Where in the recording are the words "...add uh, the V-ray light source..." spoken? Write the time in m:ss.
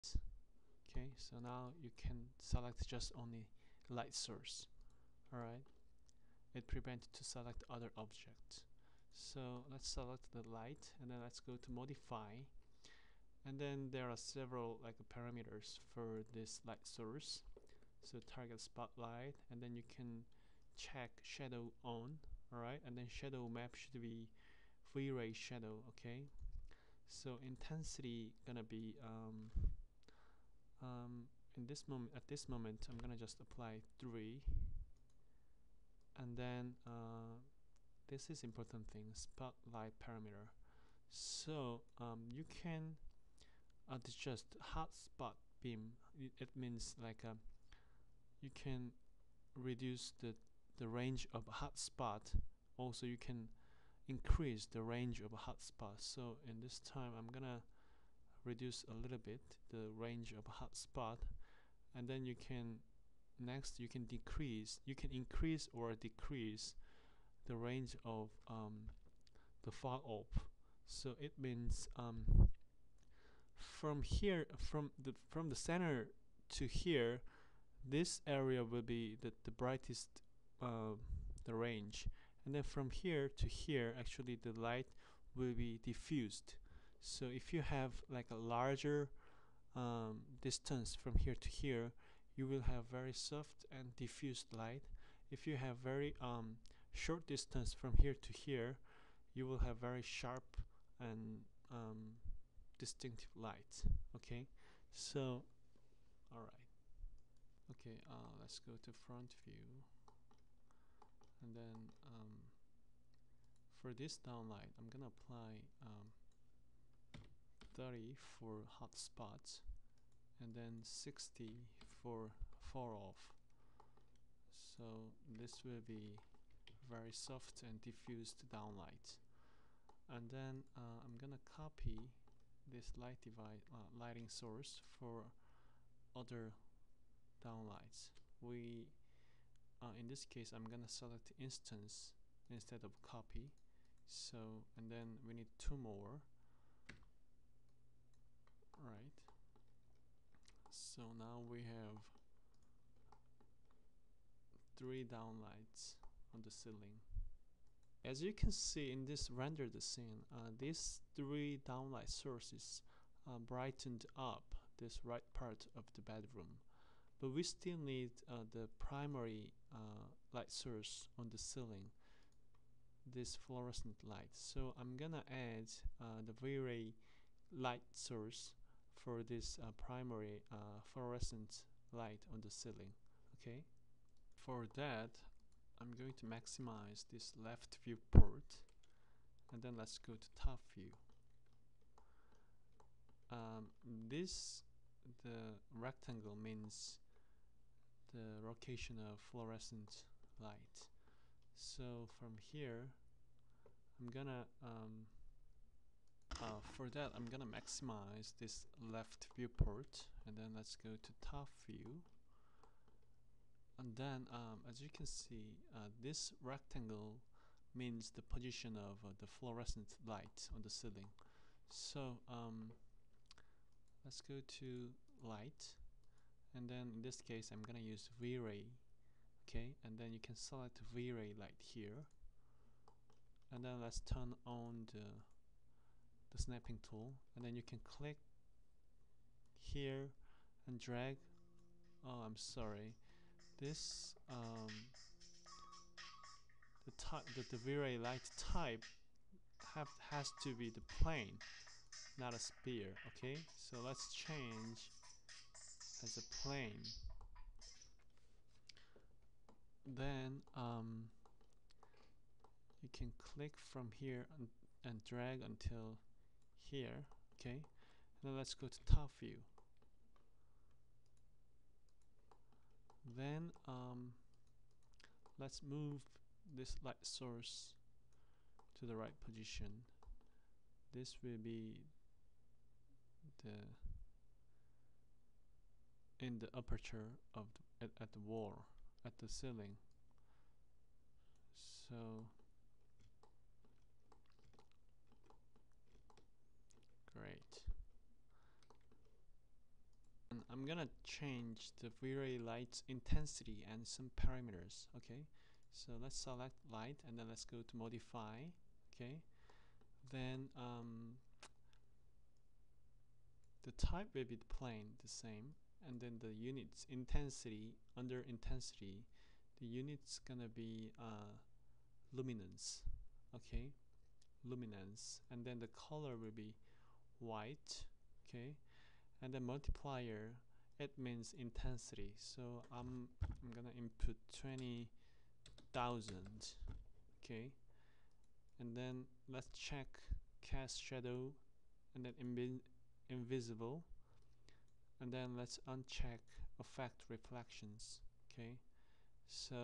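2:55.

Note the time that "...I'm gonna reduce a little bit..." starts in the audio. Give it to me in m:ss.
0:57.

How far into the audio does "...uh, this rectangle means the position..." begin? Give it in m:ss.
3:35.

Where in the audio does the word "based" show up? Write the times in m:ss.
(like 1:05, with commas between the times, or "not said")
not said.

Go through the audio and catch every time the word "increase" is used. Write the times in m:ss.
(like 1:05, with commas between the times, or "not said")
0:54, 1:05.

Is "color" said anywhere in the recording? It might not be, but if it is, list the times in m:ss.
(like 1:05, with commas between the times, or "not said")
5:25.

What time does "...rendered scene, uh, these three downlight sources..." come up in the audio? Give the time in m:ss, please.
2:39.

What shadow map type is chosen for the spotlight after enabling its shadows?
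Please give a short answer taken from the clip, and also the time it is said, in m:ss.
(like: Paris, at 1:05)
V-Ray shadow, at 0:24.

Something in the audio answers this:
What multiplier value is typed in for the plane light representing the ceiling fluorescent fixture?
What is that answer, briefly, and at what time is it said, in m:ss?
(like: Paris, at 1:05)
20,000, at 5:34.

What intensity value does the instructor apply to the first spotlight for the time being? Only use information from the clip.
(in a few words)
3.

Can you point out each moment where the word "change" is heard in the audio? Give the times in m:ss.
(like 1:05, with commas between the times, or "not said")
4:14, 5:01.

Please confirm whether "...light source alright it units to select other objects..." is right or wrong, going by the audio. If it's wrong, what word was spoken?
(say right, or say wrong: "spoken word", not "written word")
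wrong: "prevents", not "units".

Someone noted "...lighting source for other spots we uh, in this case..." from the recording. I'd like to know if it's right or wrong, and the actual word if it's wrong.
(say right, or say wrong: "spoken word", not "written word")
wrong: "downlights", not "spots".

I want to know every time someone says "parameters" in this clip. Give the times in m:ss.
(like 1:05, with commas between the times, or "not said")
0:15, 0:40, 5:04.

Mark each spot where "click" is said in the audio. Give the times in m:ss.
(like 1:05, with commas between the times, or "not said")
3:57, 4:23.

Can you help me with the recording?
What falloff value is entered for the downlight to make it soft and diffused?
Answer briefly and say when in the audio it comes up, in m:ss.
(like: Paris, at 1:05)
60, at 2:00.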